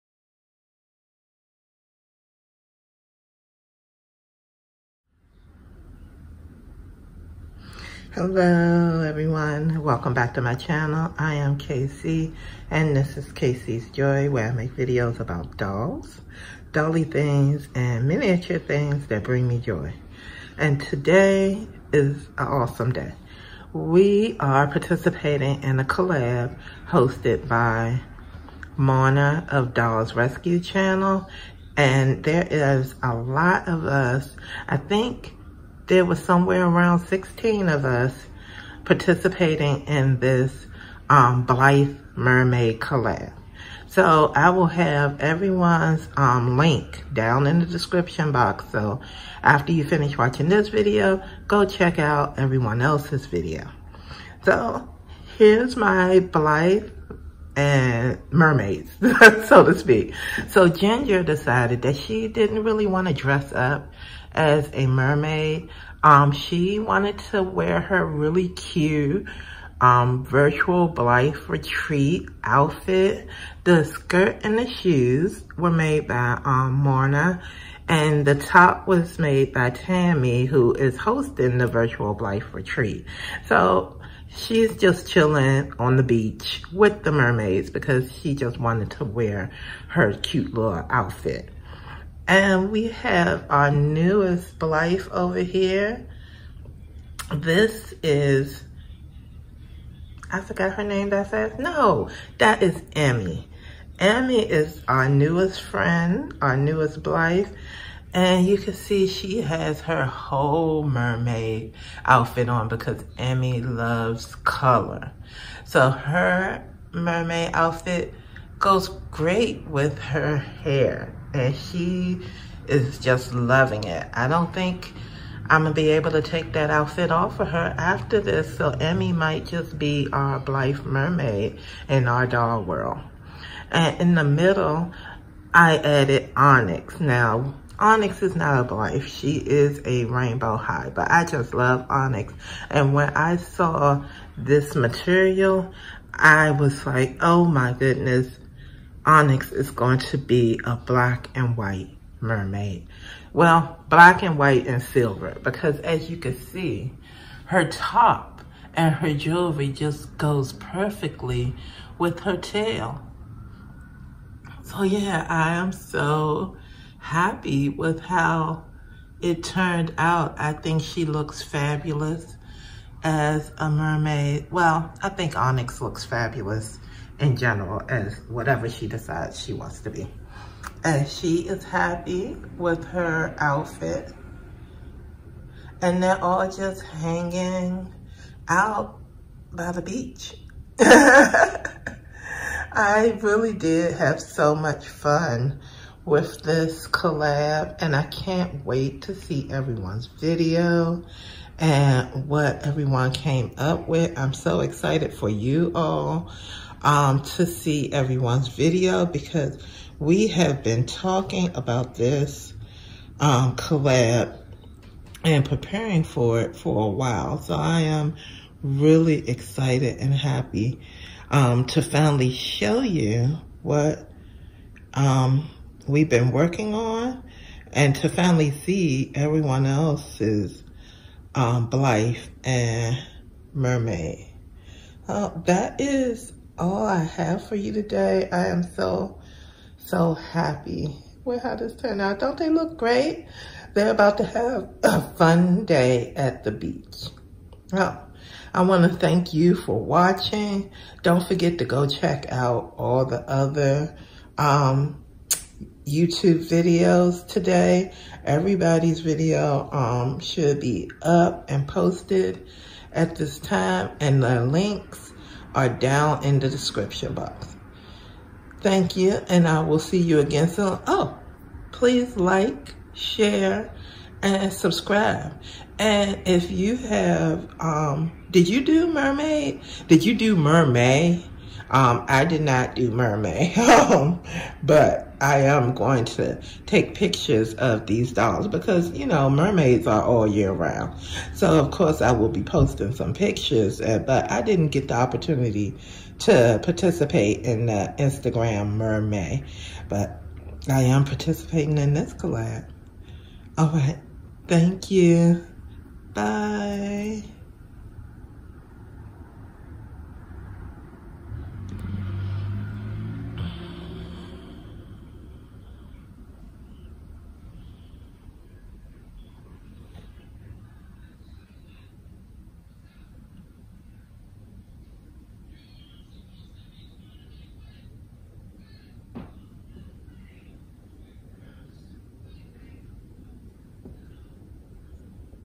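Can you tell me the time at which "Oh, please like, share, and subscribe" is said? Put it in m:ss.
4:30.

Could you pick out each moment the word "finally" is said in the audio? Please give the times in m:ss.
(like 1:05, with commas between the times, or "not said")
3:41, 3:48.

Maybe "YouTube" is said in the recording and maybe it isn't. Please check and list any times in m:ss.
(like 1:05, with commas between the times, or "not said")
4:15.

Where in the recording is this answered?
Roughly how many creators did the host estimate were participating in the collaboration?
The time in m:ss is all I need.
0:37.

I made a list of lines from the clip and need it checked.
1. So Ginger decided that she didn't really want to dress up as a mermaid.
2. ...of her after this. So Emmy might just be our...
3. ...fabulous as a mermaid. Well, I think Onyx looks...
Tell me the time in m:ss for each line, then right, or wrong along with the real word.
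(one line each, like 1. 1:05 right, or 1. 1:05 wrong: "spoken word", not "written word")
1. 1:00 right
2. 2:07 right
3. 2:51 right.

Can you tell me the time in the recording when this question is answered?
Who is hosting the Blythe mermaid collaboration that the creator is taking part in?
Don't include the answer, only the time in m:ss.
0:28.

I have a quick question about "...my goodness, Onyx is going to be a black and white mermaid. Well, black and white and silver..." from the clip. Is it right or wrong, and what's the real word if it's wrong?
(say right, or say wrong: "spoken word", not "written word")
right.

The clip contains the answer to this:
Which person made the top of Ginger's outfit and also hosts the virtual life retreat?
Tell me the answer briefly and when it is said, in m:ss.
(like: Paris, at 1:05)
Tammy, at 1:19.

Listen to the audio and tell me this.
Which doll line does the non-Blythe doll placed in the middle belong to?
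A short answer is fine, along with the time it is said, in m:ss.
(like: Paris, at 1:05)
Rainbow High, at 2:20.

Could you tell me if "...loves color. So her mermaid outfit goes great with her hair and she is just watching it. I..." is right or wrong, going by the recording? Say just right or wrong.
wrong.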